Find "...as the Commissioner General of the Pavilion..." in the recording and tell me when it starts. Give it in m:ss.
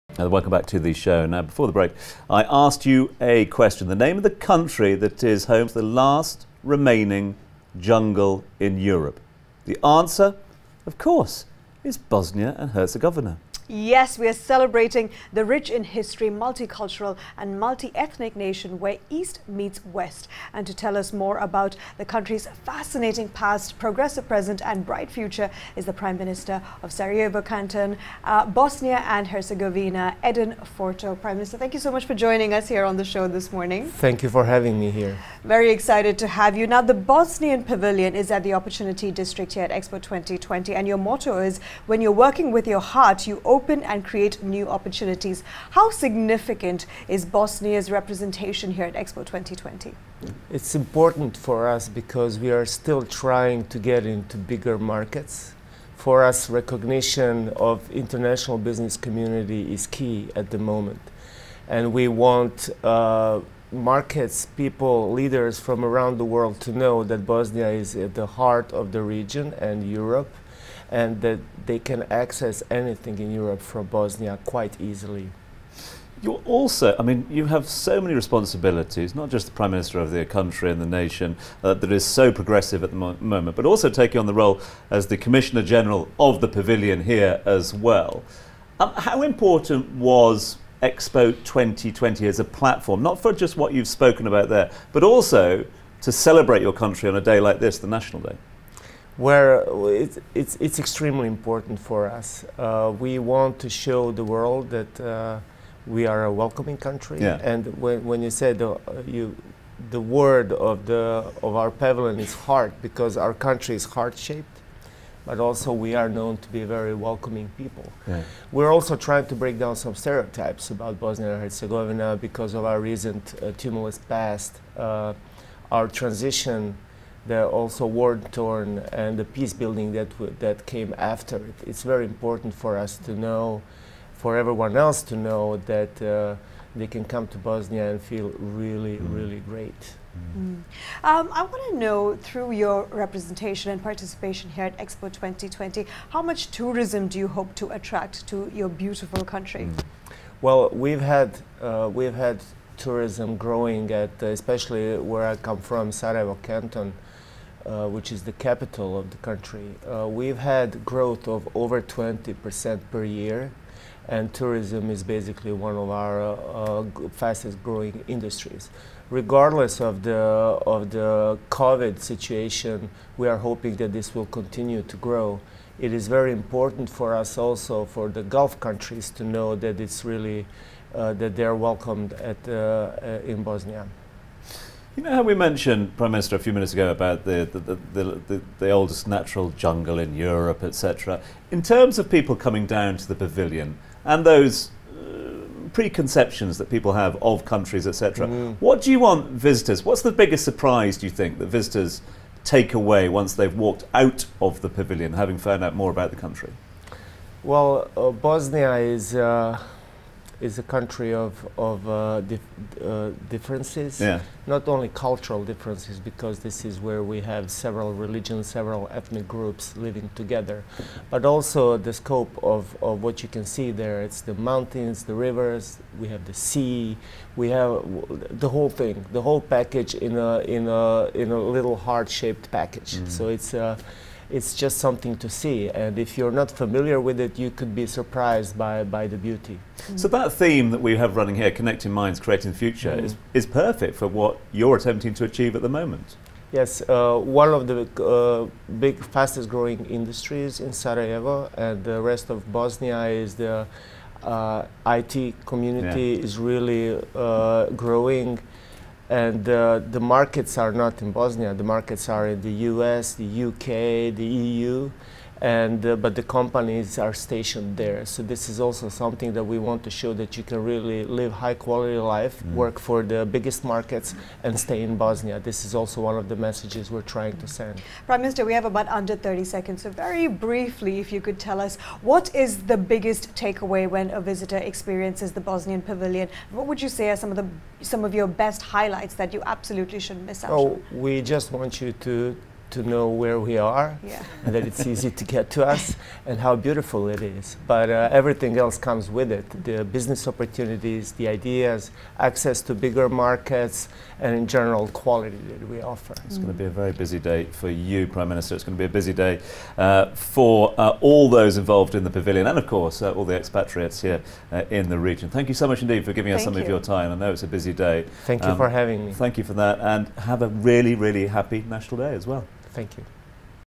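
1:24.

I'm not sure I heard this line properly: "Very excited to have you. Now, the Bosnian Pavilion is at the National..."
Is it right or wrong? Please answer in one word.
wrong.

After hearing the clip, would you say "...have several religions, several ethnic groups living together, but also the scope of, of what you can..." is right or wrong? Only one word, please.
right.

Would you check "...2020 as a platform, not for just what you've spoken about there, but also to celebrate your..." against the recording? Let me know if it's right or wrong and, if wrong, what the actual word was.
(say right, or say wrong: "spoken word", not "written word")
right.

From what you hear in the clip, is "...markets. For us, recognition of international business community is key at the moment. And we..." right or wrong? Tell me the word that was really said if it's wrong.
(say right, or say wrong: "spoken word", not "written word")
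right.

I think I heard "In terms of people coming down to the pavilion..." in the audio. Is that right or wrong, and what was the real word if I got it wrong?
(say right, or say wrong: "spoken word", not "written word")
right.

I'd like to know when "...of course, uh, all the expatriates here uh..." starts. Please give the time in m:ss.
5:12.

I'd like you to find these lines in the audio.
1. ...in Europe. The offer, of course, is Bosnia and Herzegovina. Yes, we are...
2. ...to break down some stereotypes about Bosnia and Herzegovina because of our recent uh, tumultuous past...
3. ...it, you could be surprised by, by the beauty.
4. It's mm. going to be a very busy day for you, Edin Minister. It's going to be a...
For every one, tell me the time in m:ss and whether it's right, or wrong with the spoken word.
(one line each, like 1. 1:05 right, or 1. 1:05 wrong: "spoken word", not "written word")
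1. 0:08 wrong: "answer", not "offer"
2. 1:59 right
3. 3:57 right
4. 5:06 wrong: "Prime", not "Edin".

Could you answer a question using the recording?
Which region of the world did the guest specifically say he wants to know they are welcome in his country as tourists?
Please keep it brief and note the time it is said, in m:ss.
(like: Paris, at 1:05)
Gulf countries, at 2:58.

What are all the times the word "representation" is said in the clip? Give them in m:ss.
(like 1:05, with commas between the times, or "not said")
0:47, 2:22.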